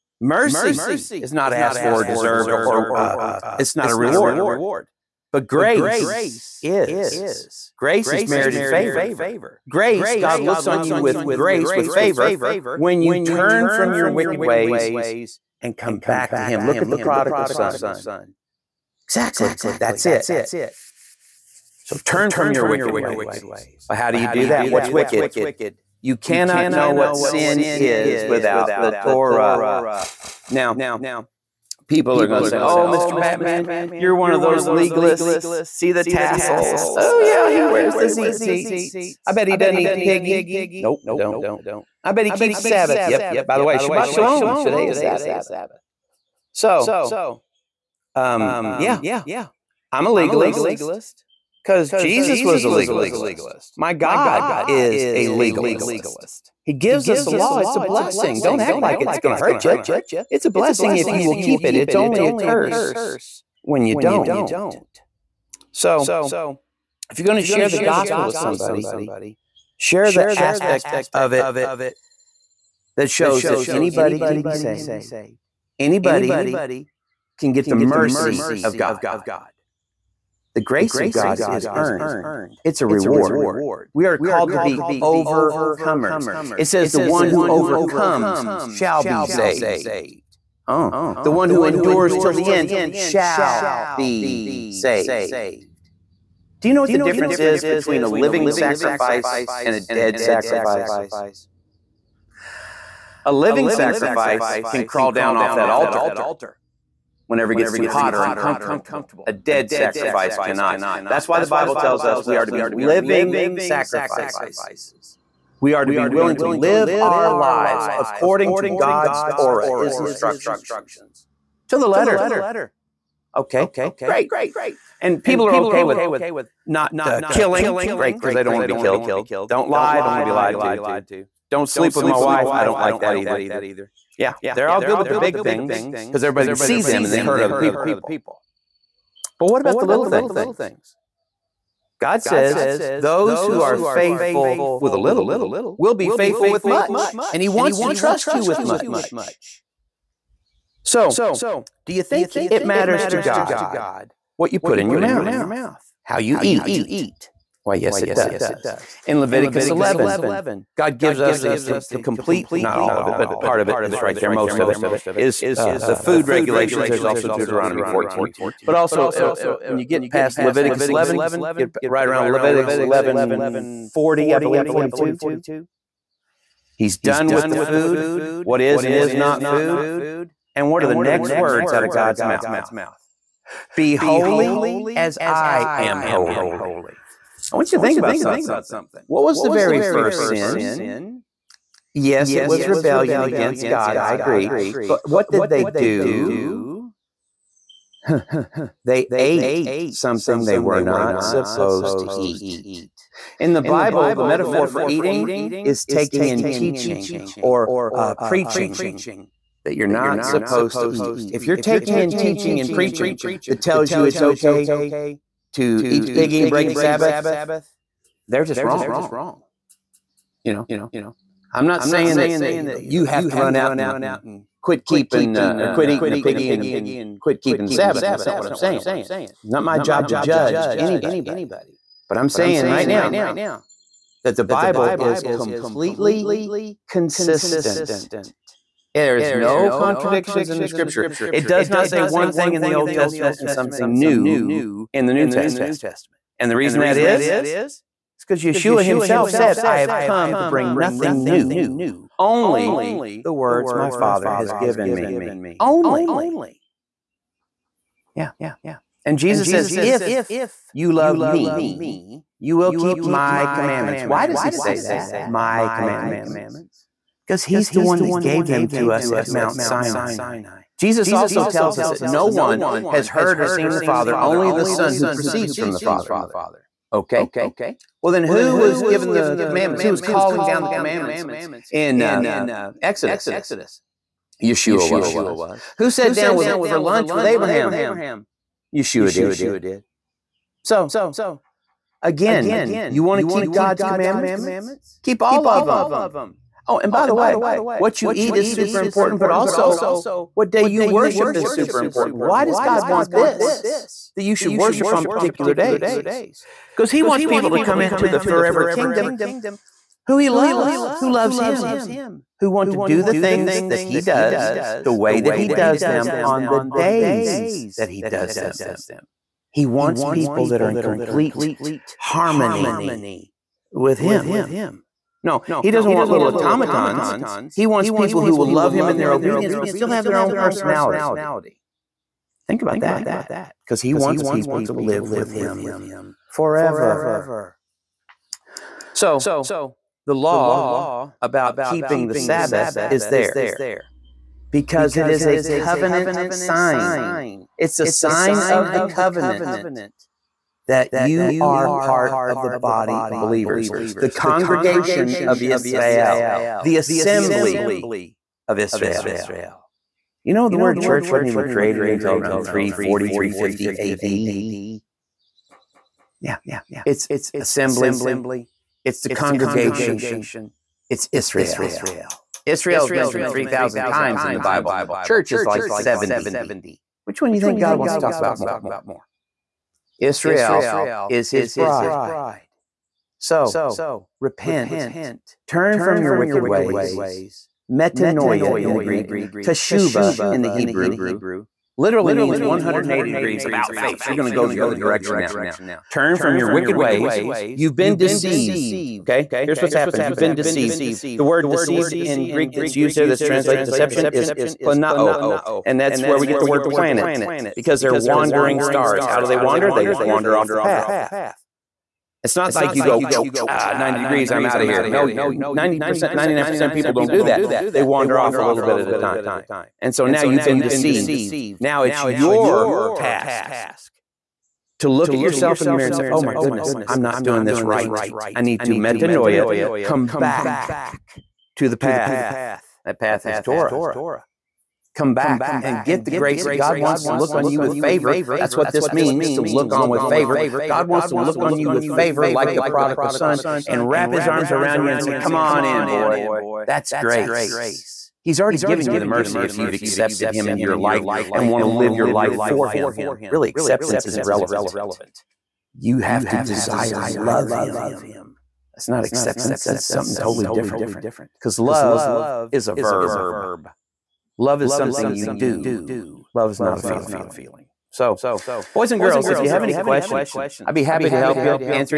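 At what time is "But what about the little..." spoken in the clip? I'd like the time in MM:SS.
02:19.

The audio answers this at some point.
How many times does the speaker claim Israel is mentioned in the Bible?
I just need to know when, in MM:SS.
06:13.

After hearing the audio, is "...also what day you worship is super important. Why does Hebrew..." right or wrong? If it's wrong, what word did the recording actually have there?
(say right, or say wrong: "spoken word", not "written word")
wrong: "God", not "Hebrew".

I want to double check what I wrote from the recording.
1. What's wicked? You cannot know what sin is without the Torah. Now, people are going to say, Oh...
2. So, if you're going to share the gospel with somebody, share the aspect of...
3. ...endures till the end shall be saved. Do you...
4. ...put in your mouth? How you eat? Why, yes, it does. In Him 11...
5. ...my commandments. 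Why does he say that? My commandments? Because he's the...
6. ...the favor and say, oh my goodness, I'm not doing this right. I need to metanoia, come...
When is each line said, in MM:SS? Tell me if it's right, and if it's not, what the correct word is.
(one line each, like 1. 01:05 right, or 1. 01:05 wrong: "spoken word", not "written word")
1. 00:24 right
2. 01:05 right
3. 01:31 right
4. 02:34 wrong: "Leviticus", not "Him"
5. 04:23 right
6. 07:05 wrong: "mirror", not "favor".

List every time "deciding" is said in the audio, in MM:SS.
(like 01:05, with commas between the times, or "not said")
not said.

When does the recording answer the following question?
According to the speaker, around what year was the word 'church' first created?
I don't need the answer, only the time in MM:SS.
06:02.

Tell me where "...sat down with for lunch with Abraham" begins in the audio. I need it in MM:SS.
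04:45.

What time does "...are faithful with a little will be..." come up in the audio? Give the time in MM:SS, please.
02:23.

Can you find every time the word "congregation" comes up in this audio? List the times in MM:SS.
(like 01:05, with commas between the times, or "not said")
05:54, 06:09.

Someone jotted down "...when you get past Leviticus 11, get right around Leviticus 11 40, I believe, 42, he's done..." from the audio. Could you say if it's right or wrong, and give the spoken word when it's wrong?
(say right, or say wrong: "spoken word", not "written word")
right.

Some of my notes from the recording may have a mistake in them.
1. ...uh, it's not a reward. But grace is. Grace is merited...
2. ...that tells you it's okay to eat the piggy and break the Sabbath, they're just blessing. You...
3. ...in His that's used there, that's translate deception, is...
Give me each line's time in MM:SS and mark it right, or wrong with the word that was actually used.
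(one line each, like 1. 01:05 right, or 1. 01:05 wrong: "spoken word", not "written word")
1. 00:02 right
2. 03:33 wrong: "wrong", not "blessing"
3. 06:42 wrong: "Greek", not "His".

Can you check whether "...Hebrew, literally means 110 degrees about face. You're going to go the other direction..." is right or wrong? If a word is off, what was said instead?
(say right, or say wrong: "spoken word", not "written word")
wrong: "180", not "110".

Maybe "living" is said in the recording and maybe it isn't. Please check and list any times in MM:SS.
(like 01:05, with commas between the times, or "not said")
01:38, 01:43, 01:52.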